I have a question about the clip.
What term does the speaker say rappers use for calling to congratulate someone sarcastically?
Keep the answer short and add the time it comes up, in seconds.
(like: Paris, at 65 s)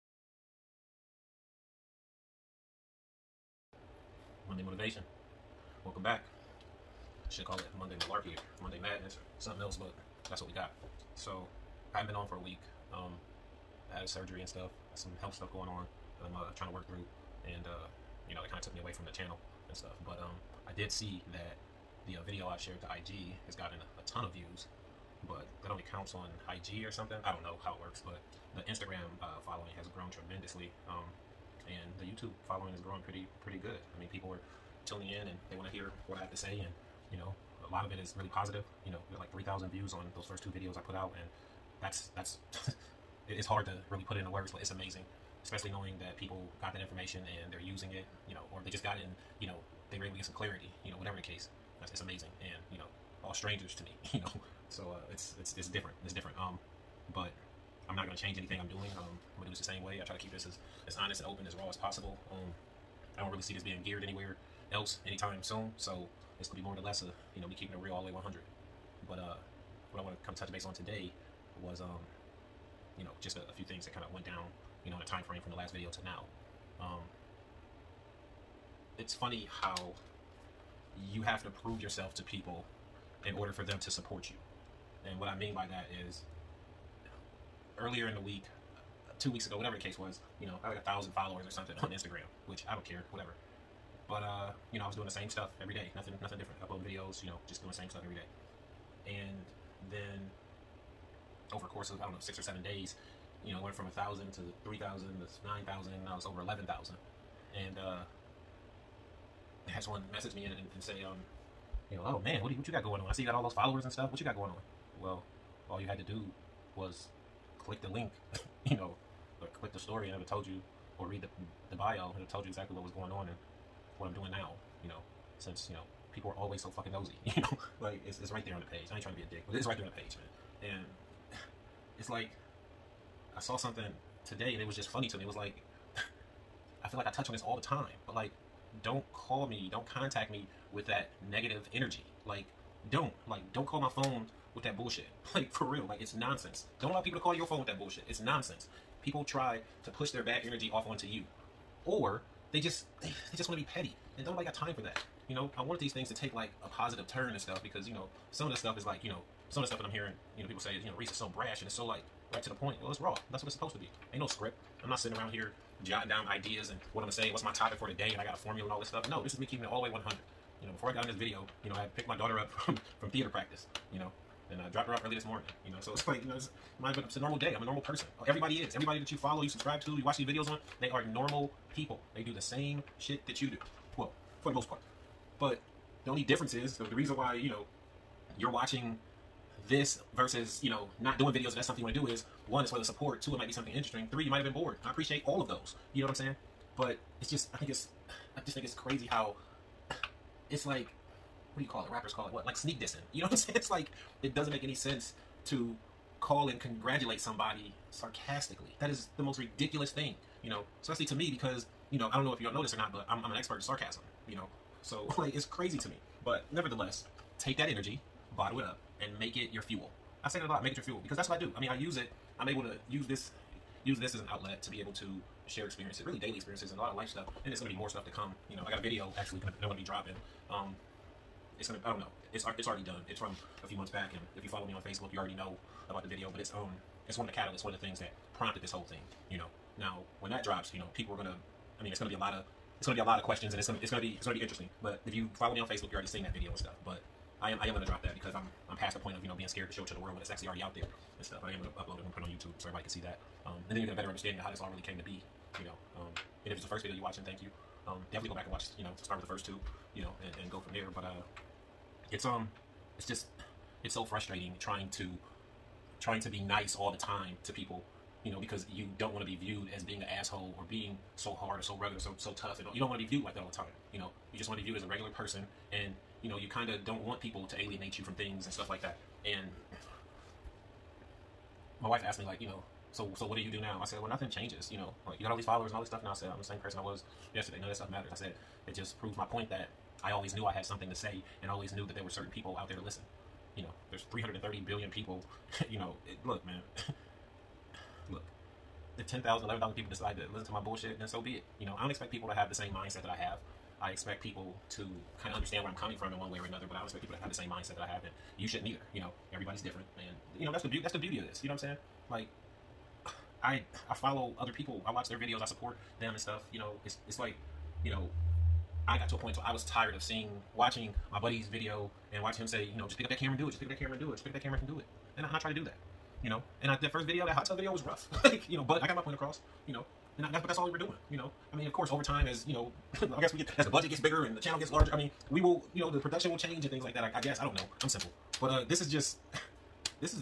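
sneak dissing, at 202 s.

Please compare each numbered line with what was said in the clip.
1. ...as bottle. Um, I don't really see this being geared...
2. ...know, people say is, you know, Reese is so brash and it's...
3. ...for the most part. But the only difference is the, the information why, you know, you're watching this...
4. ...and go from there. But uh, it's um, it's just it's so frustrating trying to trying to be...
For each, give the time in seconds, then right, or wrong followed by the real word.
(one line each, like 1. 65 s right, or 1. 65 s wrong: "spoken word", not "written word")
1. 61 s wrong: "possible", not "bottle"
2. 160 s right
3. 184 s wrong: "reason", not "information"
4. 260 s right.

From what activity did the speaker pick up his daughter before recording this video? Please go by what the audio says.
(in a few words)
theater practice.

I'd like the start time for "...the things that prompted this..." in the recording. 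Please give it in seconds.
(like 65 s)
237 s.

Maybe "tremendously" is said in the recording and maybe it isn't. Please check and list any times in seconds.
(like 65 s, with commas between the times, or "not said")
30 s.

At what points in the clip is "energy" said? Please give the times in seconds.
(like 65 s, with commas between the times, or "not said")
141 s, 150 s, 217 s.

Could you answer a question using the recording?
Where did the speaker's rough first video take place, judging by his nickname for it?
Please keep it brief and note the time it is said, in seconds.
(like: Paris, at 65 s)
hot tub, at 327 s.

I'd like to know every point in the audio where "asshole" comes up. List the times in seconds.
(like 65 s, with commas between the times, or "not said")
270 s.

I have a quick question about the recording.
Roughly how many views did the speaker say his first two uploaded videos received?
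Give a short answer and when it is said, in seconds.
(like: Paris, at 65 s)
3,000, at 39 s.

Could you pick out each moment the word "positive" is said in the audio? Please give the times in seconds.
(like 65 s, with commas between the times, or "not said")
38 s, 156 s.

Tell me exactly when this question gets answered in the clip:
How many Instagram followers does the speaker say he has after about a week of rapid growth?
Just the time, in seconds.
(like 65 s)
106 s.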